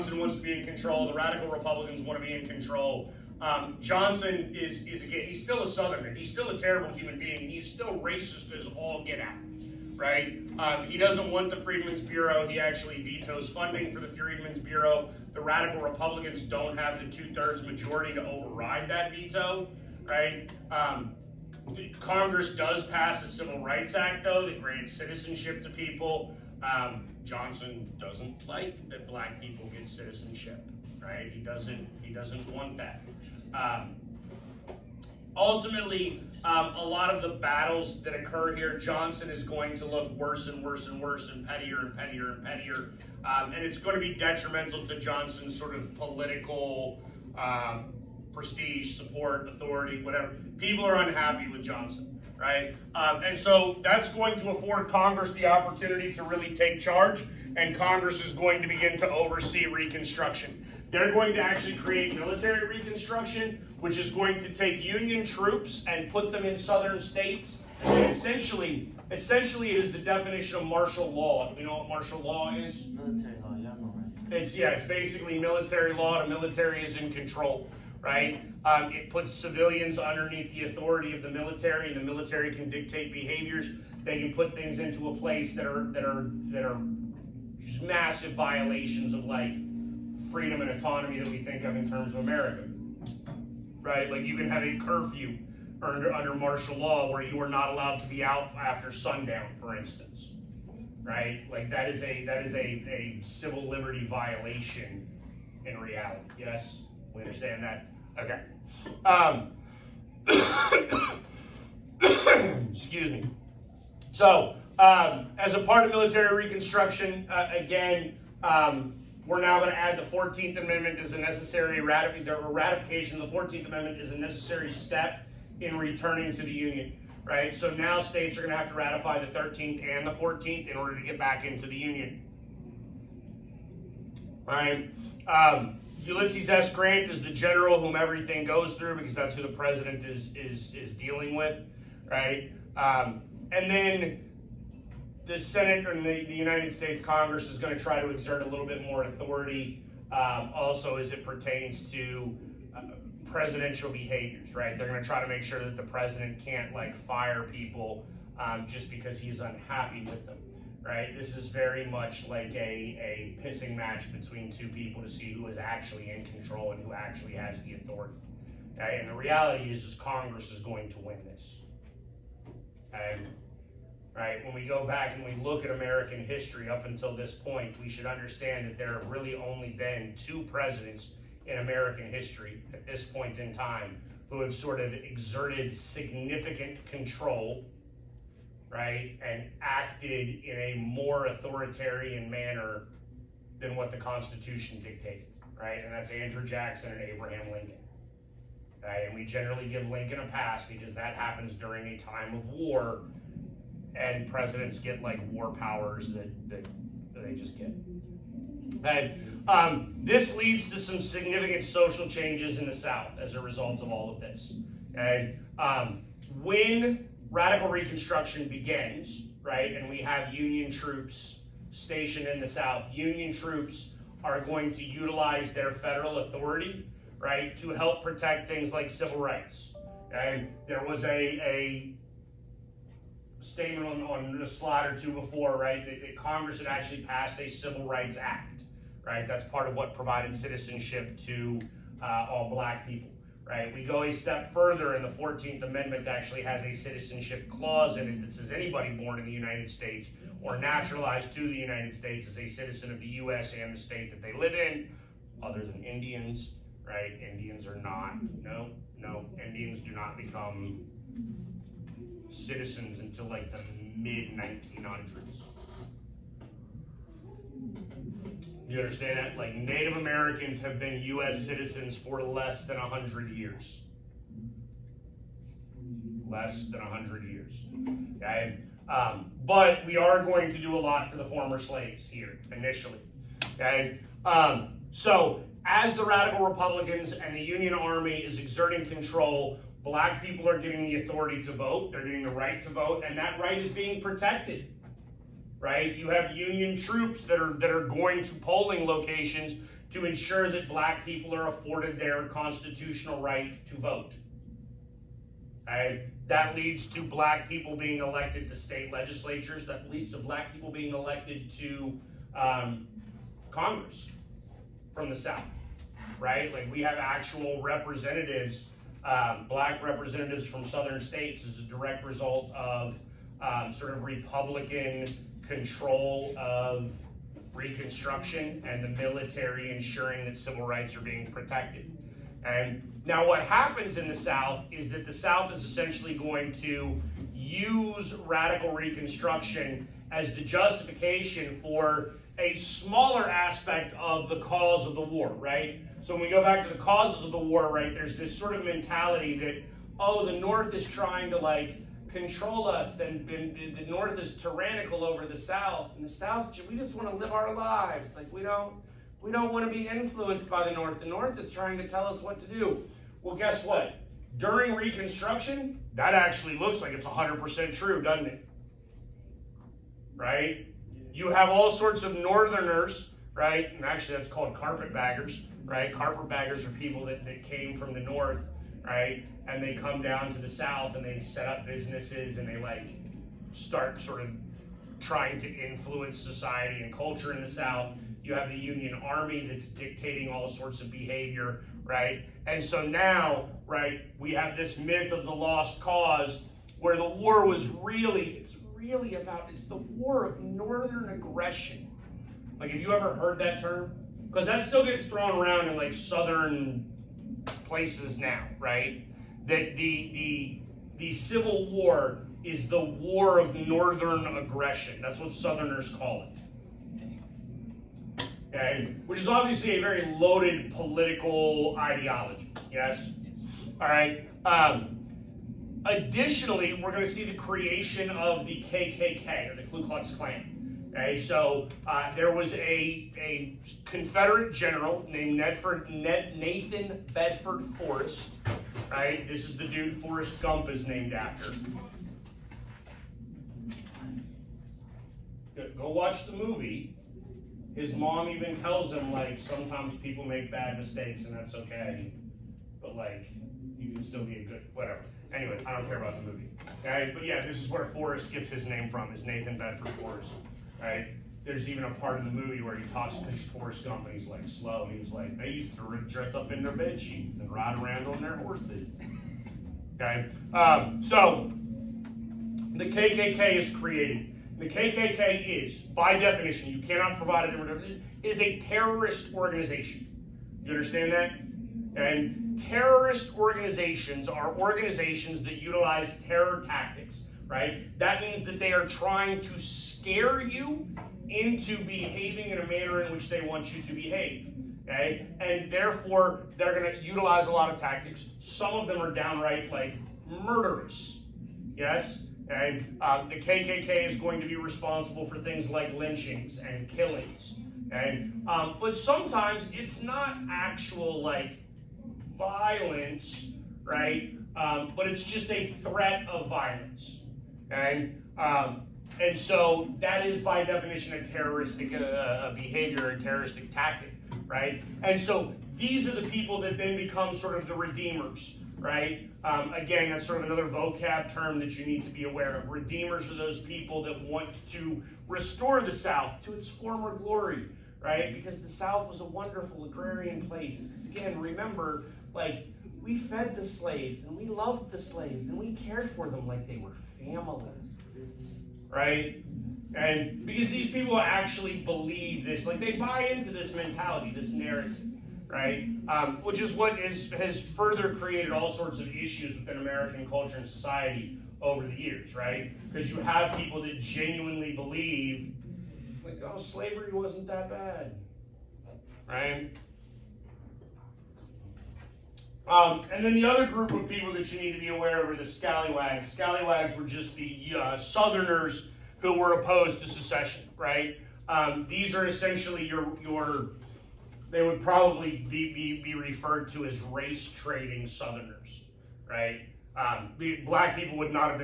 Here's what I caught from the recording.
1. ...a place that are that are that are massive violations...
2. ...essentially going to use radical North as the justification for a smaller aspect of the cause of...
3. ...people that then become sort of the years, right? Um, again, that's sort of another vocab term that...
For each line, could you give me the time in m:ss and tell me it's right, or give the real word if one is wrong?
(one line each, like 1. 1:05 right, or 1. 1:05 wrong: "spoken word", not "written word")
1. 1:25 right
2. 5:35 wrong: "Reconstruction", not "North"
3. 8:46 wrong: "redeemers", not "years".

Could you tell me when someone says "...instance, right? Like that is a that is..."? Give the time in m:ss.
1:39.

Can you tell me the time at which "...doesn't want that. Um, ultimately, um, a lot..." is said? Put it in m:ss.
0:32.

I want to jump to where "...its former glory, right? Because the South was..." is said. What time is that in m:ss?
8:56.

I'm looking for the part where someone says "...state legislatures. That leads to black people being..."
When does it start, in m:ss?
5:08.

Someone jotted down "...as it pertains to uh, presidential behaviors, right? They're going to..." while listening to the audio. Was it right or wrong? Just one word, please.
right.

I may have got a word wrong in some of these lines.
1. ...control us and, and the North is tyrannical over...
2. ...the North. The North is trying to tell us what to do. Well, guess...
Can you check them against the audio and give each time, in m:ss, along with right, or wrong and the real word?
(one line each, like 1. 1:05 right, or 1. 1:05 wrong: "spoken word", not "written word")
1. 5:52 right
2. 6:00 right.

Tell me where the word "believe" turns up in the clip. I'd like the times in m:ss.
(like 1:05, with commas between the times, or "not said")
9:11, 9:24.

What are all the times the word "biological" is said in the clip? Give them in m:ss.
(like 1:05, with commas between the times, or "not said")
not said.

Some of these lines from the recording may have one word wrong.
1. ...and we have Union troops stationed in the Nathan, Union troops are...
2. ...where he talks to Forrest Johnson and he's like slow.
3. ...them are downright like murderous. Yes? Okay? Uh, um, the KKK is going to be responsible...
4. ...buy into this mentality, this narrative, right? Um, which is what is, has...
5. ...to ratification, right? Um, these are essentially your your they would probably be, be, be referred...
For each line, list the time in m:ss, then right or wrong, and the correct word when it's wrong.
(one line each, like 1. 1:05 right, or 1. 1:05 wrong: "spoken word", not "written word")
1. 3:39 wrong: "South", not "Nathan"
2. 7:42 wrong: "Gump", not "Johnson"
3. 8:18 right
4. 9:12 right
5. 9:40 wrong: "secession", not "ratification".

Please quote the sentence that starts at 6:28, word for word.
You have the Union Army that's dictating all sorts of behavior, right?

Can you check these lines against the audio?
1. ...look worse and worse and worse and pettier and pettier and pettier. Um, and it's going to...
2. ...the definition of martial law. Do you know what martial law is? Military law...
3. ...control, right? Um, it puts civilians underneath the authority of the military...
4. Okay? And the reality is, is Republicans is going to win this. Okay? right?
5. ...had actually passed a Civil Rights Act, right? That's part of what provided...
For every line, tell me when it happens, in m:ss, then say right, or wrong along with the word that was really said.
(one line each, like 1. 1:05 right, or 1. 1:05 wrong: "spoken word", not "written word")
1. 0:39 right
2. 1:09 right
3. 1:17 right
4. 2:48 wrong: "Congress", not "Republicans"
5. 3:56 right.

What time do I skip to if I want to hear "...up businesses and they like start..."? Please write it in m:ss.
6:21.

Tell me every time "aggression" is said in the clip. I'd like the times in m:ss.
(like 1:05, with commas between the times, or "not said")
6:41, 6:54.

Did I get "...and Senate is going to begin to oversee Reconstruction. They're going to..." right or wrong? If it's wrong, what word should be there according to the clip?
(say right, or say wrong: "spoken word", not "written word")
wrong: "Congress", not "Senate".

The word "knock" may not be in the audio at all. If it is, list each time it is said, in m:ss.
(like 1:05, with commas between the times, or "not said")
not said.